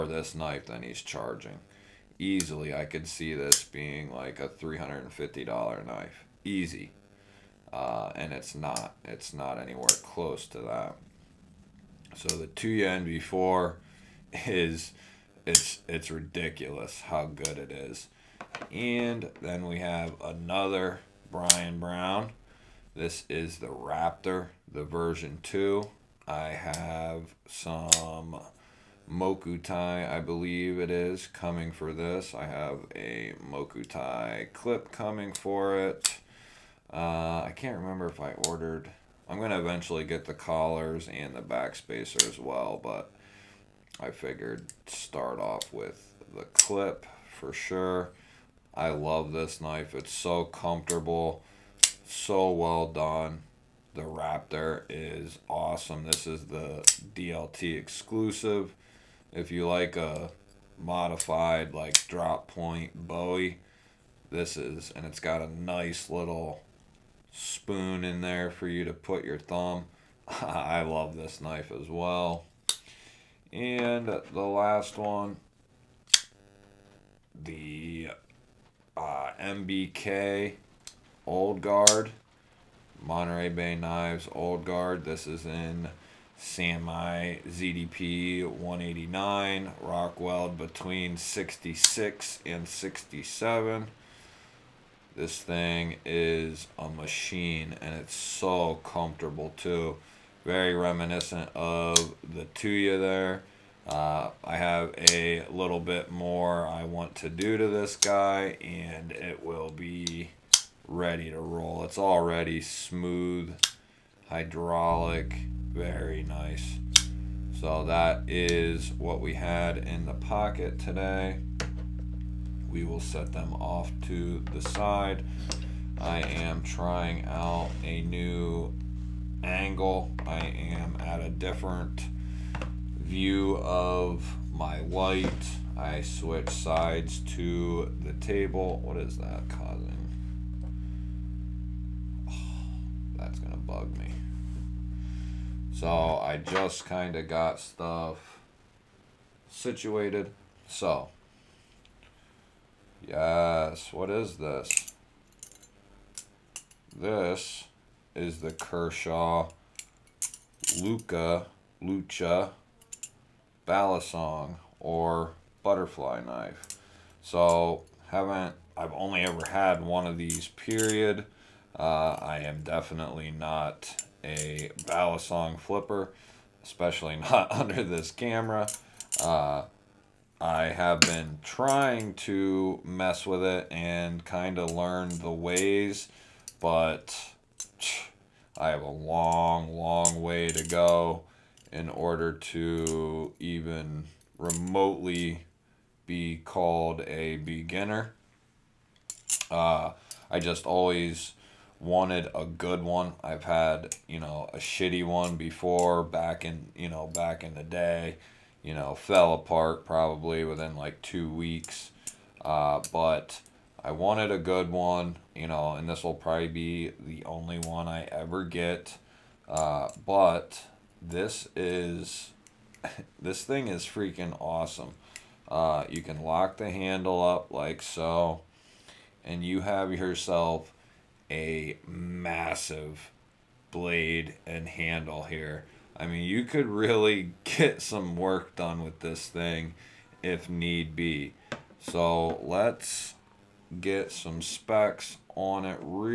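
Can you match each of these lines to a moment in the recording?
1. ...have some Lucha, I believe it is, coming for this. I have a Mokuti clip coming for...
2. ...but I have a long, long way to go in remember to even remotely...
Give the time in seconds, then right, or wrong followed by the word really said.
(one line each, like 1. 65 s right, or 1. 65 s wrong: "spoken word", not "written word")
1. 26 s wrong: "Mokuti", not "Lucha"
2. 186 s wrong: "order", not "remember".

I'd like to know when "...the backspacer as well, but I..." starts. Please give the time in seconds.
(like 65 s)
41 s.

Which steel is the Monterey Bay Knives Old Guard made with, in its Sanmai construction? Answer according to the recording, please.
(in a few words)
ZDP 189.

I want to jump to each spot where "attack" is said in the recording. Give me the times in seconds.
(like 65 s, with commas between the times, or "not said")
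not said.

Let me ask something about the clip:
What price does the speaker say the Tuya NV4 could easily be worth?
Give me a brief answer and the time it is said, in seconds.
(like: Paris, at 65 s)
$350, at 4 s.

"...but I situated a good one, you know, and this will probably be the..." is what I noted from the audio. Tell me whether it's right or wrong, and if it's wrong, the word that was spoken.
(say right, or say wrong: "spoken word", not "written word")
wrong: "wanted", not "situated".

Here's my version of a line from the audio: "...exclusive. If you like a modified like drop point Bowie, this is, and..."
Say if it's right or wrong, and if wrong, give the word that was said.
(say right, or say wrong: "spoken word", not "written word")
right.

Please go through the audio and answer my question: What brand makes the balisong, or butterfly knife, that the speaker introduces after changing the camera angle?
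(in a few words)
Kershaw.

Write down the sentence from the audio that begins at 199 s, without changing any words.
Uh, I just always wanted a good one.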